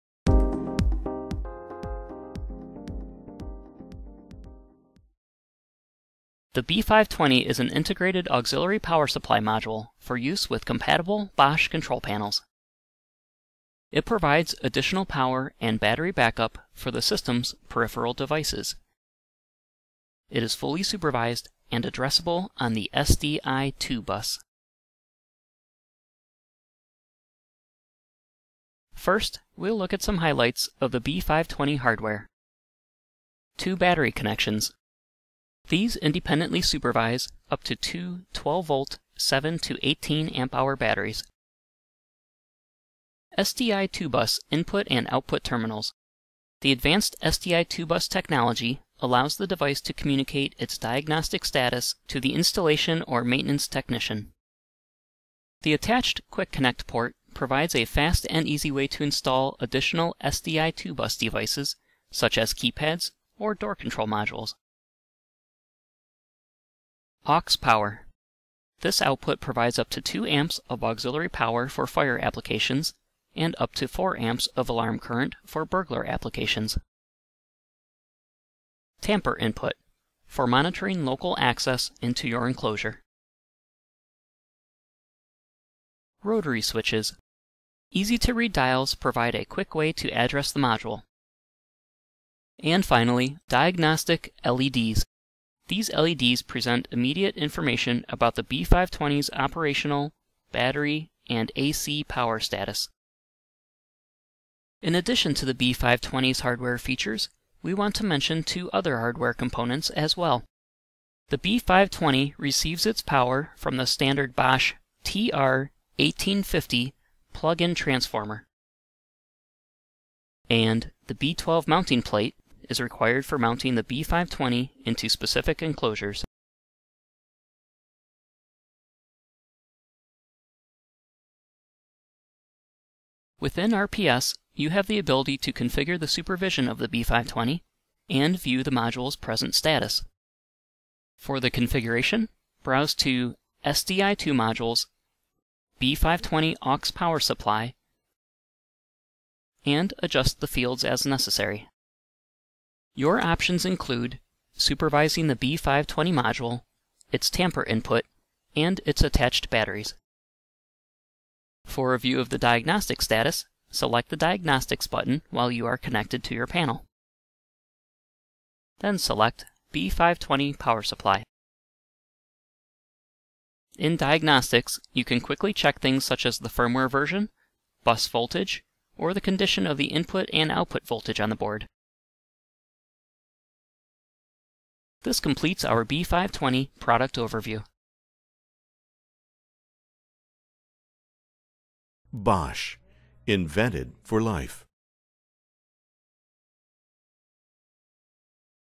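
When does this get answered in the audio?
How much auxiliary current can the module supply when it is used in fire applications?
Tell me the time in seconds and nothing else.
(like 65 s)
70 s.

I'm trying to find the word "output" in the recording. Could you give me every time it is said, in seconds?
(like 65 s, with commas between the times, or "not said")
45 s, 69 s, 180 s.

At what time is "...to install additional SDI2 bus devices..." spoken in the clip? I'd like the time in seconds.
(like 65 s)
58 s.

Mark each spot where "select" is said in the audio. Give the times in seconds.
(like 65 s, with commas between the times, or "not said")
163 s, 168 s.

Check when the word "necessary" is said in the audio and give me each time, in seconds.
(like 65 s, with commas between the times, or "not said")
151 s.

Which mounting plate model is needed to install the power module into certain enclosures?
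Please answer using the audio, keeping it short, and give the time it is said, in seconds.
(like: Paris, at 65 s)
B12, at 121 s.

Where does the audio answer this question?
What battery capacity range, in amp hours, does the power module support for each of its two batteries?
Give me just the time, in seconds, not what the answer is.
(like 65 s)
39 s.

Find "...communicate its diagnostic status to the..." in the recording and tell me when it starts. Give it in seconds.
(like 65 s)
49 s.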